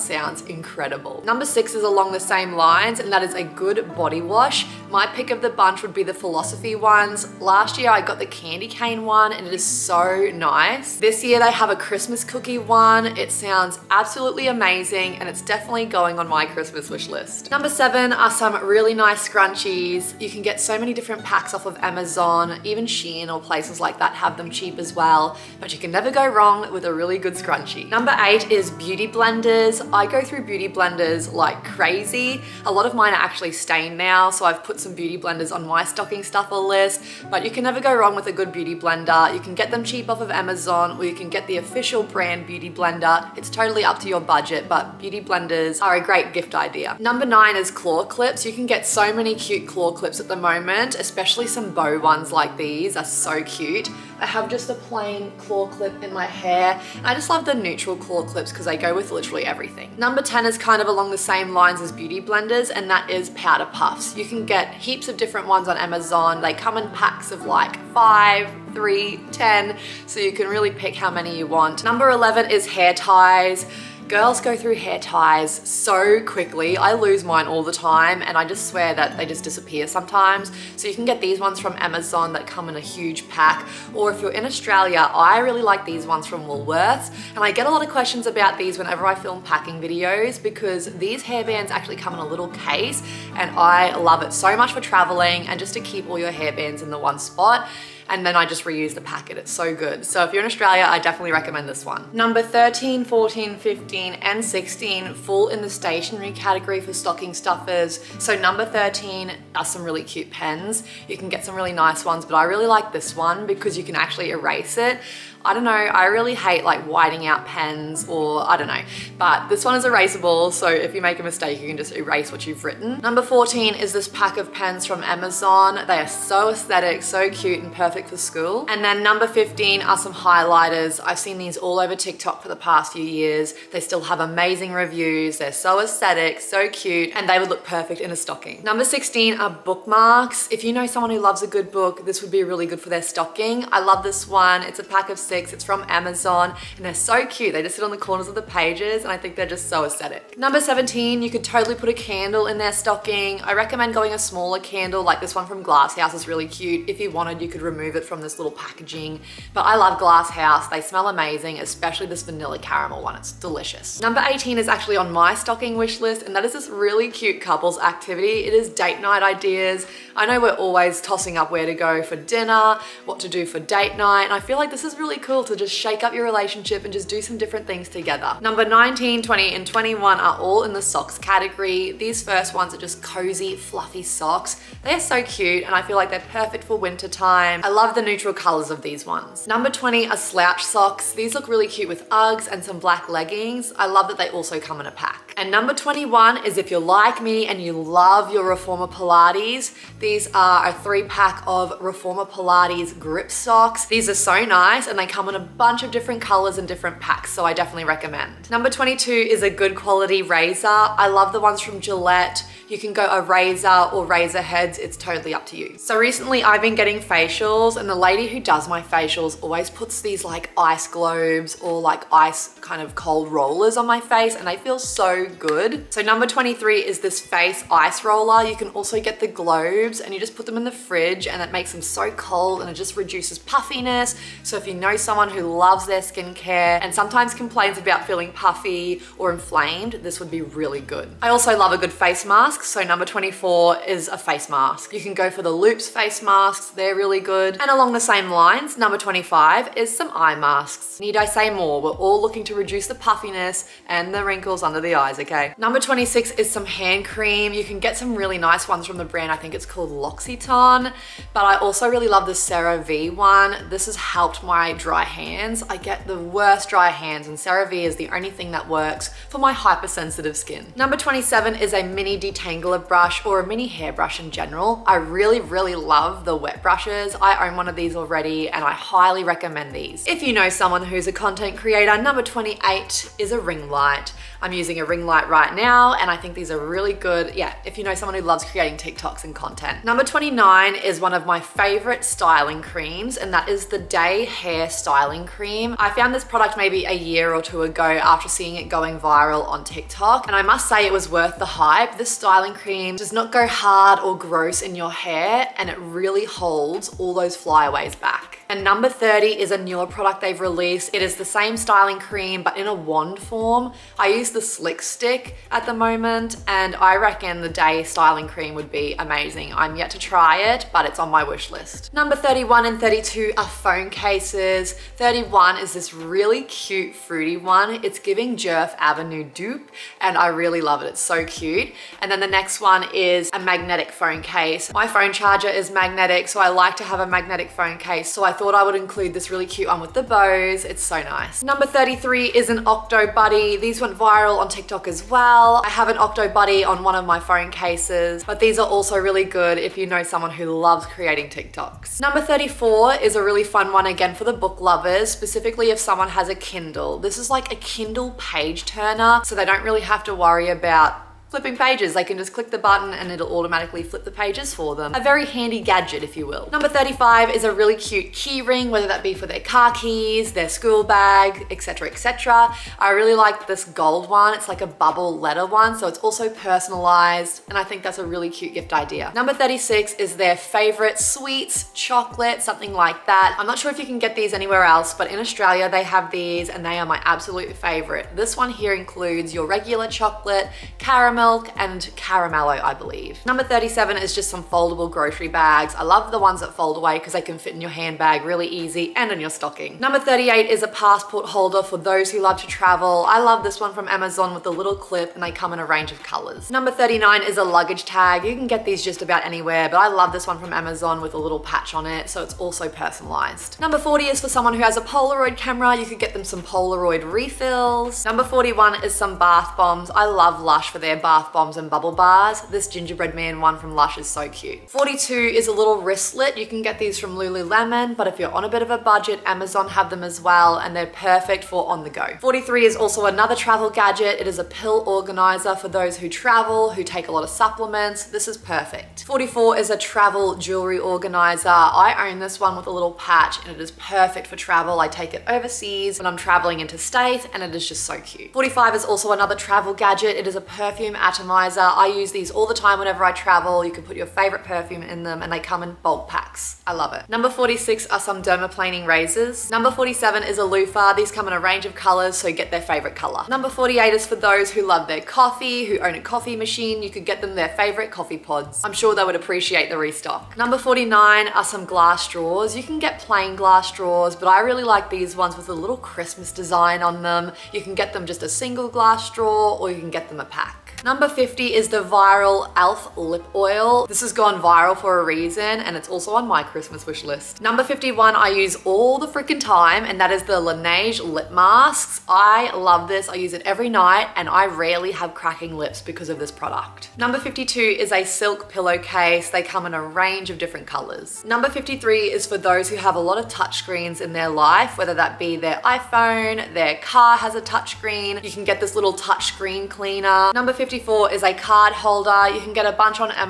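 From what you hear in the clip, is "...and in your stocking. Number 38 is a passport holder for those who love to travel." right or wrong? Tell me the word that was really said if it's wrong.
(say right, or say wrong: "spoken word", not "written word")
right.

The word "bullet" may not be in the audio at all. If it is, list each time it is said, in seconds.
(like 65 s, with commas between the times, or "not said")
not said.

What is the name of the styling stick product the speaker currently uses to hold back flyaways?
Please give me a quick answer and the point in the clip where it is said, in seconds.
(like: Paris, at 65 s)
Slick Stick, at 314 s.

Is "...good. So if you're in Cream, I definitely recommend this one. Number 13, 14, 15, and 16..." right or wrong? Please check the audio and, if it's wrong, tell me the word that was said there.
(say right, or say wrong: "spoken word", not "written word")
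wrong: "Australia", not "Cream".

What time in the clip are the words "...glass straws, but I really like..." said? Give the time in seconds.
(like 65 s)
473 s.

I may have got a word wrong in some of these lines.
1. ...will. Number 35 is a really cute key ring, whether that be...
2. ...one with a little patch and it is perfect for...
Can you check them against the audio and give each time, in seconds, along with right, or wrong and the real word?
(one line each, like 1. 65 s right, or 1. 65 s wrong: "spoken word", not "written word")
1. 366 s right
2. 442 s right.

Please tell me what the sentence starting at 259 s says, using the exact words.
I think it's called L'Occitane, but I also really love the CeraVe one.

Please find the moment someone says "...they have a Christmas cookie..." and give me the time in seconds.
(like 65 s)
11 s.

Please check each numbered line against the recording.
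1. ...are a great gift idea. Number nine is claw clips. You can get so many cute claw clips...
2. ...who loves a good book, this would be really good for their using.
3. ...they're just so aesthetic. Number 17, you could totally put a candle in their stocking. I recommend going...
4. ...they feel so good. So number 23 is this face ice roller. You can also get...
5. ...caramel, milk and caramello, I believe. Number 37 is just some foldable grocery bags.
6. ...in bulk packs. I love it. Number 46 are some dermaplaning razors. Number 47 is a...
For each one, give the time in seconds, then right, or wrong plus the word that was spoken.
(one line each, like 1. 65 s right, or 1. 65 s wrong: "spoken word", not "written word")
1. 45 s right
2. 141 s wrong: "stocking", not "using"
3. 149 s right
4. 224 s right
5. 390 s right
6. 455 s right.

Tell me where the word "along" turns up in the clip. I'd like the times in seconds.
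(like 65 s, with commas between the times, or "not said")
1 s, 60 s, 247 s.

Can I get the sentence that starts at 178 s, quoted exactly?
Number 19, 20, and 21 are all in the socks category.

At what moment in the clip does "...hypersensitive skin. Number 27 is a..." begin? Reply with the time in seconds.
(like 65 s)
269 s.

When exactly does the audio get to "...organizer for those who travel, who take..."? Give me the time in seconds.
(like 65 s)
434 s.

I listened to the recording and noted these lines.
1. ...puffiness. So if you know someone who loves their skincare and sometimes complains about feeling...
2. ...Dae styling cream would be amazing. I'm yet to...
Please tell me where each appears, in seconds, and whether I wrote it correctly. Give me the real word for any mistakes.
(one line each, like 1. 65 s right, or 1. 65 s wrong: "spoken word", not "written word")
1. 233 s right
2. 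317 s right.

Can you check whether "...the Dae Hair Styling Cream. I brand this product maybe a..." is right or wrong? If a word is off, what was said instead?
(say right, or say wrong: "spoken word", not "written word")
wrong: "found", not "brand".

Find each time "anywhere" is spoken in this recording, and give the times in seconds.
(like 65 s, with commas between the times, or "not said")
384 s, 409 s.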